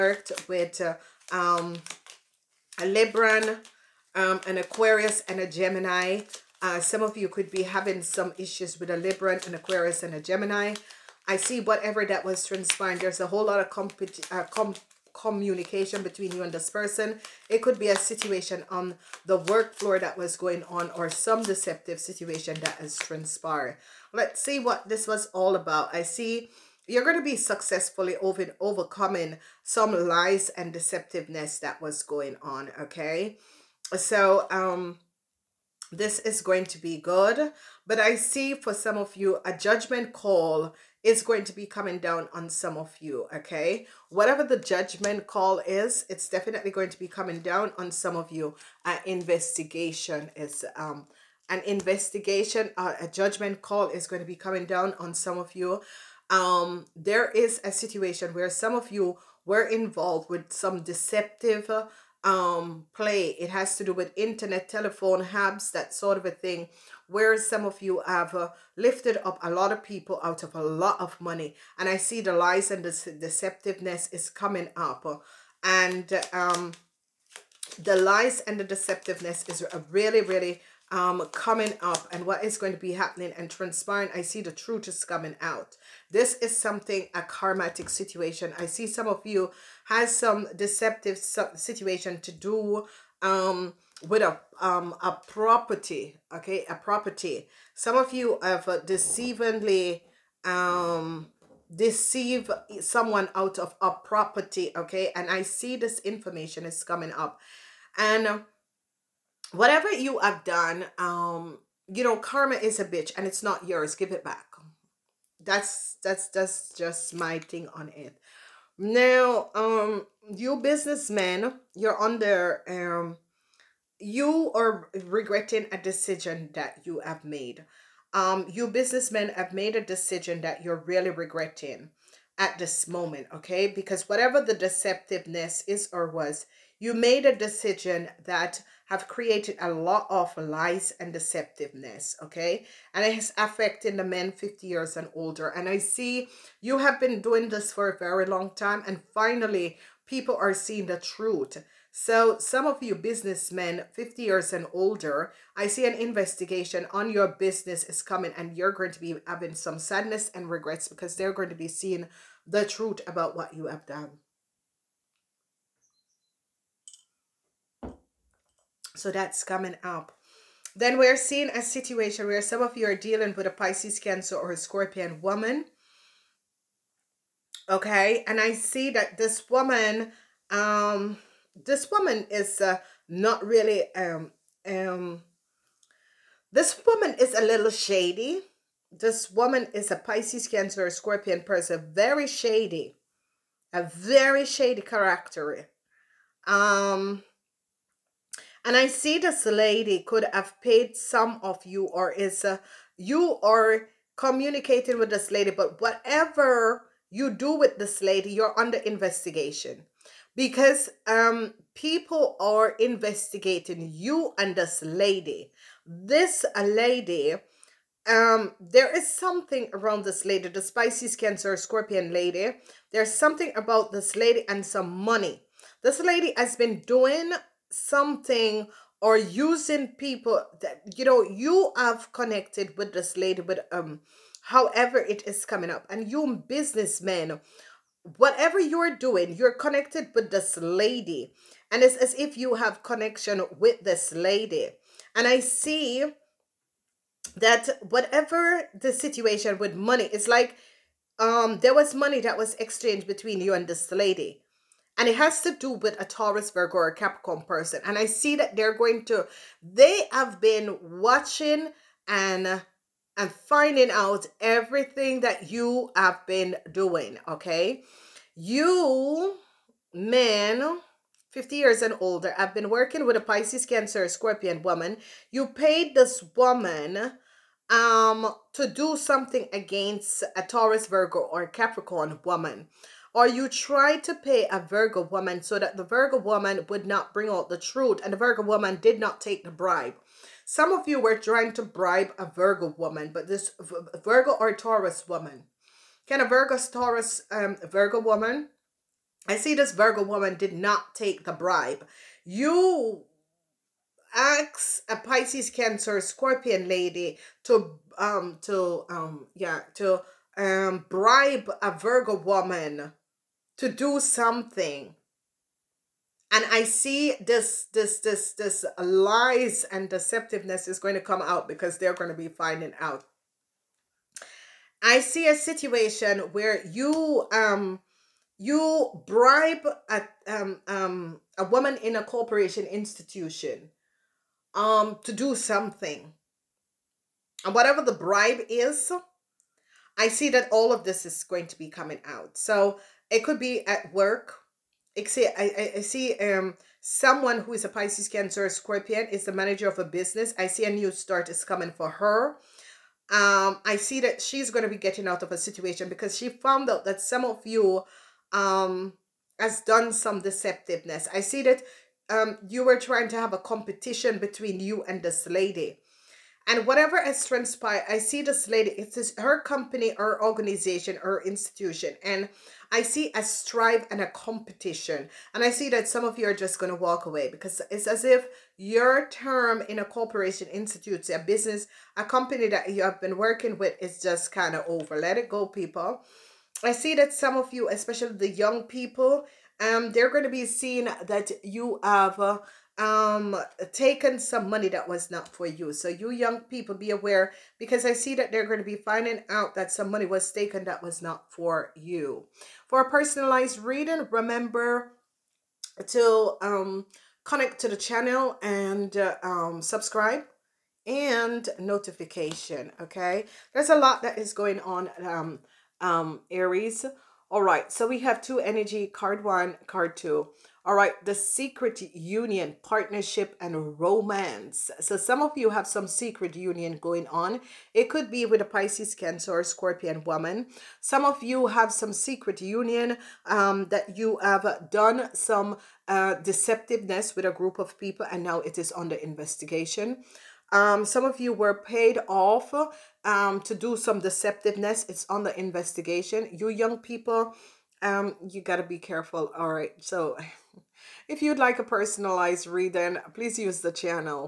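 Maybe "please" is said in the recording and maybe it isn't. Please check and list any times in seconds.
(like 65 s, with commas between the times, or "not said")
453 s.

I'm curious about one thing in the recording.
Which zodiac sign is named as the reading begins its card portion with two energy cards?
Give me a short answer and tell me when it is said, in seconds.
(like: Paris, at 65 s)
Aries, at 416 s.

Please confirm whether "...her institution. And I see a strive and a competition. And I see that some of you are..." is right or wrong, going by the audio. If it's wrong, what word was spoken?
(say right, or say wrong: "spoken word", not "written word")
right.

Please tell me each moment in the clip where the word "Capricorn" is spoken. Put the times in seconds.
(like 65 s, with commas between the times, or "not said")
256 s, 281 s.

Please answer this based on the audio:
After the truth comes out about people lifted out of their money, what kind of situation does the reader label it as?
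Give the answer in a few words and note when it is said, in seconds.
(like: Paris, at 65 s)
karmatic situation, at 87 s.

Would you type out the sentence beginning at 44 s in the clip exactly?
Whatever the judgment call is, it's definitely going to be coming down on some of you.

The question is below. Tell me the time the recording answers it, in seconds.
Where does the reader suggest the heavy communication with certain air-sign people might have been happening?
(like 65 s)
19 s.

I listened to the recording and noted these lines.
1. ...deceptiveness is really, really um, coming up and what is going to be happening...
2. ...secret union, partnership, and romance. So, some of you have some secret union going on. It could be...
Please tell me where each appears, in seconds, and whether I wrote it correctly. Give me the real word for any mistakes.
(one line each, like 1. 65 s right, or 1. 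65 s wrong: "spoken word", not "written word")
1. 78 s right
2. 421 s right.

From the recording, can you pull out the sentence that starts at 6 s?
Uh, some of you could be having some issues with a Libran, an Aquarius, and a Gemini.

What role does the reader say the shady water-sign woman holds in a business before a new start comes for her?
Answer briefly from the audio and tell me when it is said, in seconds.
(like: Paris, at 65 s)
manager, at 349 s.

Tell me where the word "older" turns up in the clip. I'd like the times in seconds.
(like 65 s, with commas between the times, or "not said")
145 s, 154 s, 271 s.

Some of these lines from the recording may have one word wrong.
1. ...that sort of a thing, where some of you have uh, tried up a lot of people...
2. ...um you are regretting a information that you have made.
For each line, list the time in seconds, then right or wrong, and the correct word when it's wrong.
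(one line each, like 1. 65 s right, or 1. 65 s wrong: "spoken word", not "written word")
1. 65 s wrong: "lifted", not "tried"
2. 122 s wrong: "decision", not "information".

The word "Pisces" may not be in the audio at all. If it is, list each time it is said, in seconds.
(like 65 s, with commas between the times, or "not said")
173 s, 189 s, 220 s, 273 s, 304 s, 347 s, 428 s.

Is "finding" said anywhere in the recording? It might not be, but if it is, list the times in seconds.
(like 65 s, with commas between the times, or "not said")
263 s, 322 s, 398 s.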